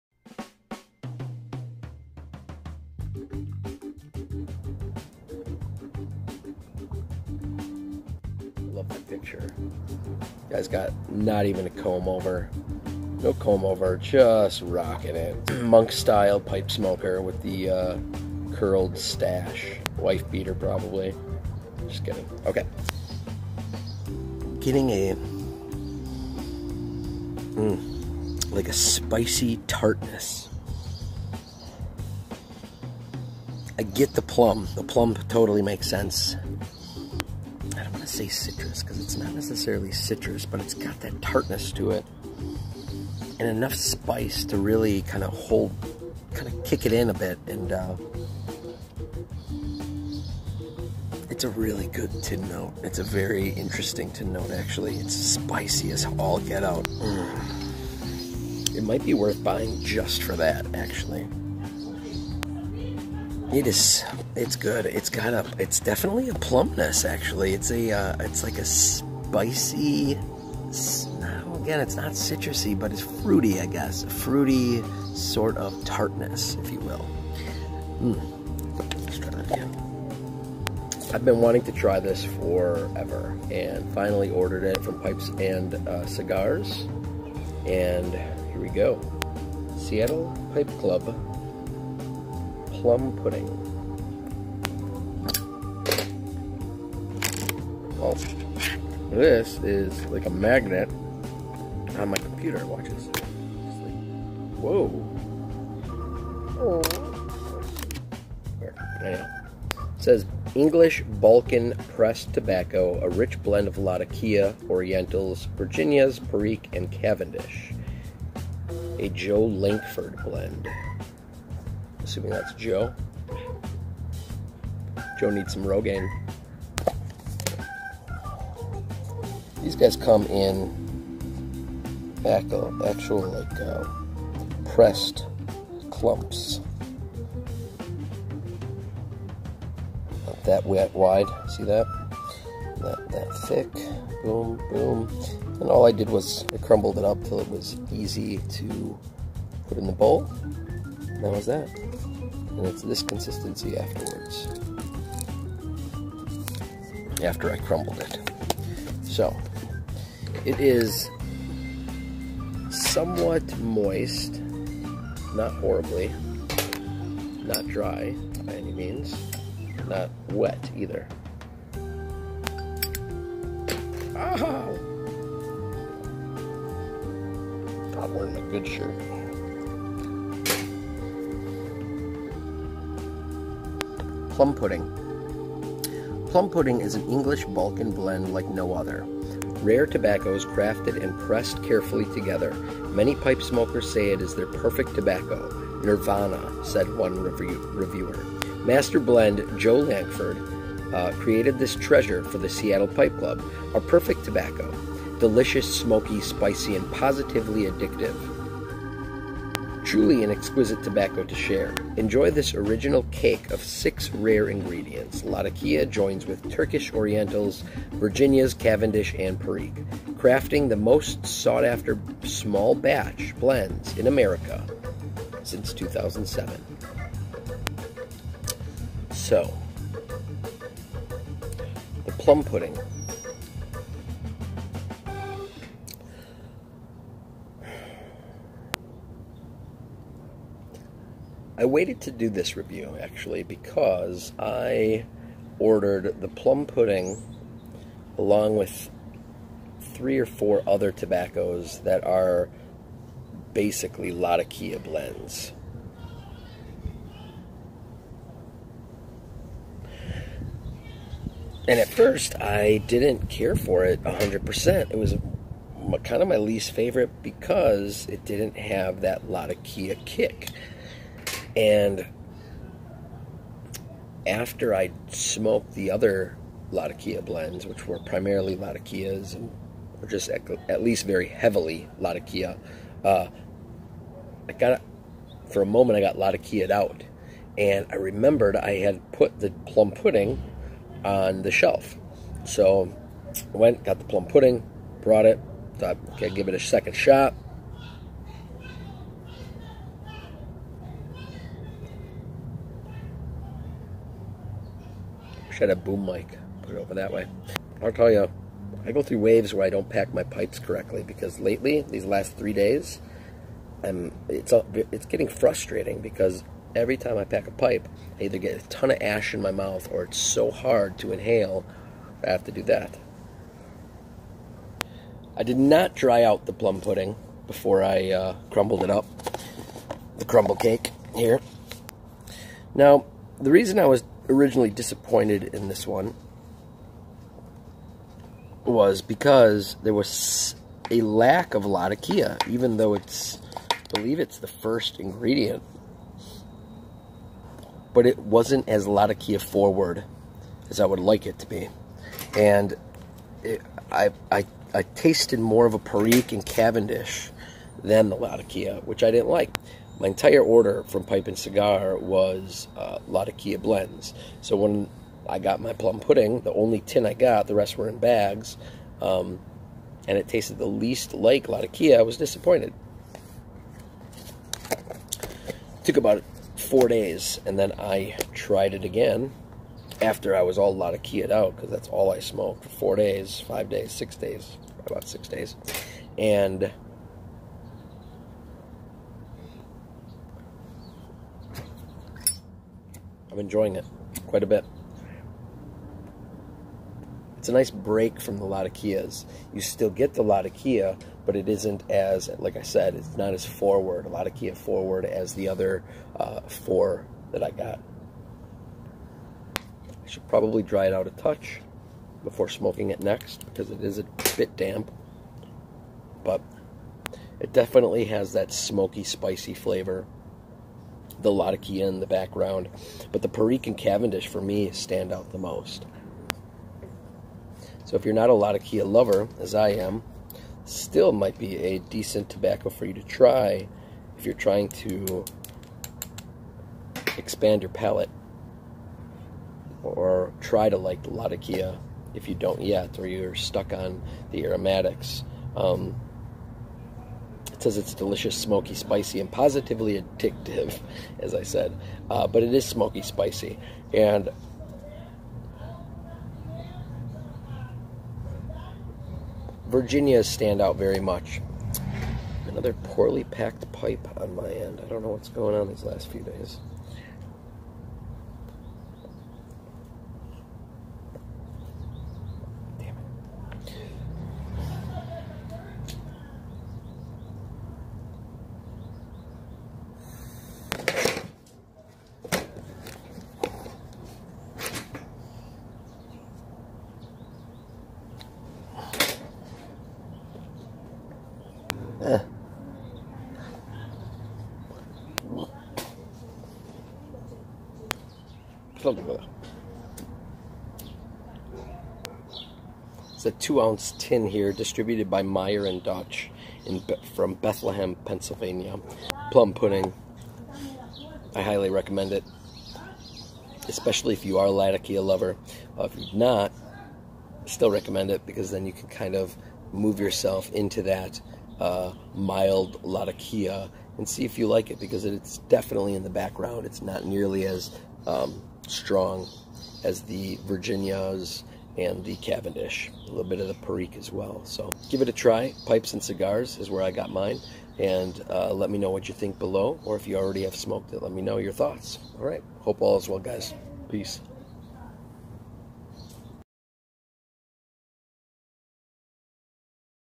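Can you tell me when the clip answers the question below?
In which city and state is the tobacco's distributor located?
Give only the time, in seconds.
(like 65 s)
507 s.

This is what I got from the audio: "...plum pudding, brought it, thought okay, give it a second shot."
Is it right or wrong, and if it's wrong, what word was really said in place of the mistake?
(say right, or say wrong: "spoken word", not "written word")
right.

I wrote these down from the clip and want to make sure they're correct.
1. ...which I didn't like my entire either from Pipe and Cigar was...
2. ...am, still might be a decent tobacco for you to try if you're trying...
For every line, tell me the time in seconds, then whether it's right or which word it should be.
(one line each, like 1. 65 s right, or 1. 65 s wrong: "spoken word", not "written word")
1. 358 s wrong: "order", not "either"
2. 429 s right.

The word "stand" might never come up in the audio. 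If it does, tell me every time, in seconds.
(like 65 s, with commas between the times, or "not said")
424 s, 460 s.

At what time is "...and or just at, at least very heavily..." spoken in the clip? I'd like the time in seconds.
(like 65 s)
279 s.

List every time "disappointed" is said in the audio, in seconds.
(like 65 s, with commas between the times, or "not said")
334 s, 372 s.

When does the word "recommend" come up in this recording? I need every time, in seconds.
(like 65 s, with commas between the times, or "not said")
511 s, 517 s.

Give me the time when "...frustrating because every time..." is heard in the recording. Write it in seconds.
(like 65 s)
315 s.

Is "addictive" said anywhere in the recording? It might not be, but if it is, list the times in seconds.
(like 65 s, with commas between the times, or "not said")
207 s, 450 s.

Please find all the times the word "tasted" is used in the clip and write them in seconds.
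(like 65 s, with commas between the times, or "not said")
354 s, 370 s.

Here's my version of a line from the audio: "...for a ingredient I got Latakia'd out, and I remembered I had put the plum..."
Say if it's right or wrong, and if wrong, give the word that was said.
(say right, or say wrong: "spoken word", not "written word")
wrong: "moment", not "ingredient".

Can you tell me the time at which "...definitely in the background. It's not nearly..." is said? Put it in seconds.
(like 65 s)
525 s.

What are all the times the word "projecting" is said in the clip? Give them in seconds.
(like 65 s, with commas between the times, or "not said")
not said.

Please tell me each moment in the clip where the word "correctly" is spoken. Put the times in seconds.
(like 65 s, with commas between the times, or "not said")
310 s.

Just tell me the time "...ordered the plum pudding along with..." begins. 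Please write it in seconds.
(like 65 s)
245 s.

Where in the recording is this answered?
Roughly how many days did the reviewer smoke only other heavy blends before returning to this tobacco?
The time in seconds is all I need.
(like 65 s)
384 s.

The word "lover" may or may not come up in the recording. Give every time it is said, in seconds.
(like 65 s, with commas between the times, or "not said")
428 s, 515 s.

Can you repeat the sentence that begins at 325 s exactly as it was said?
I did not dry out the plum pudding before I uh, crumbled it up, the crumble cake here.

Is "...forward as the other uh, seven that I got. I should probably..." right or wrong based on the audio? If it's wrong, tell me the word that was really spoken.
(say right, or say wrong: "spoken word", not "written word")
wrong: "four", not "seven".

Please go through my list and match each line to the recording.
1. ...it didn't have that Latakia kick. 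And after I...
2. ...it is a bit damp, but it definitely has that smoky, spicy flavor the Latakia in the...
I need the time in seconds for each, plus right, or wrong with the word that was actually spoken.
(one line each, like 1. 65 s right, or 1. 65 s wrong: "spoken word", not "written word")
1. 268 s right
2. 413 s right.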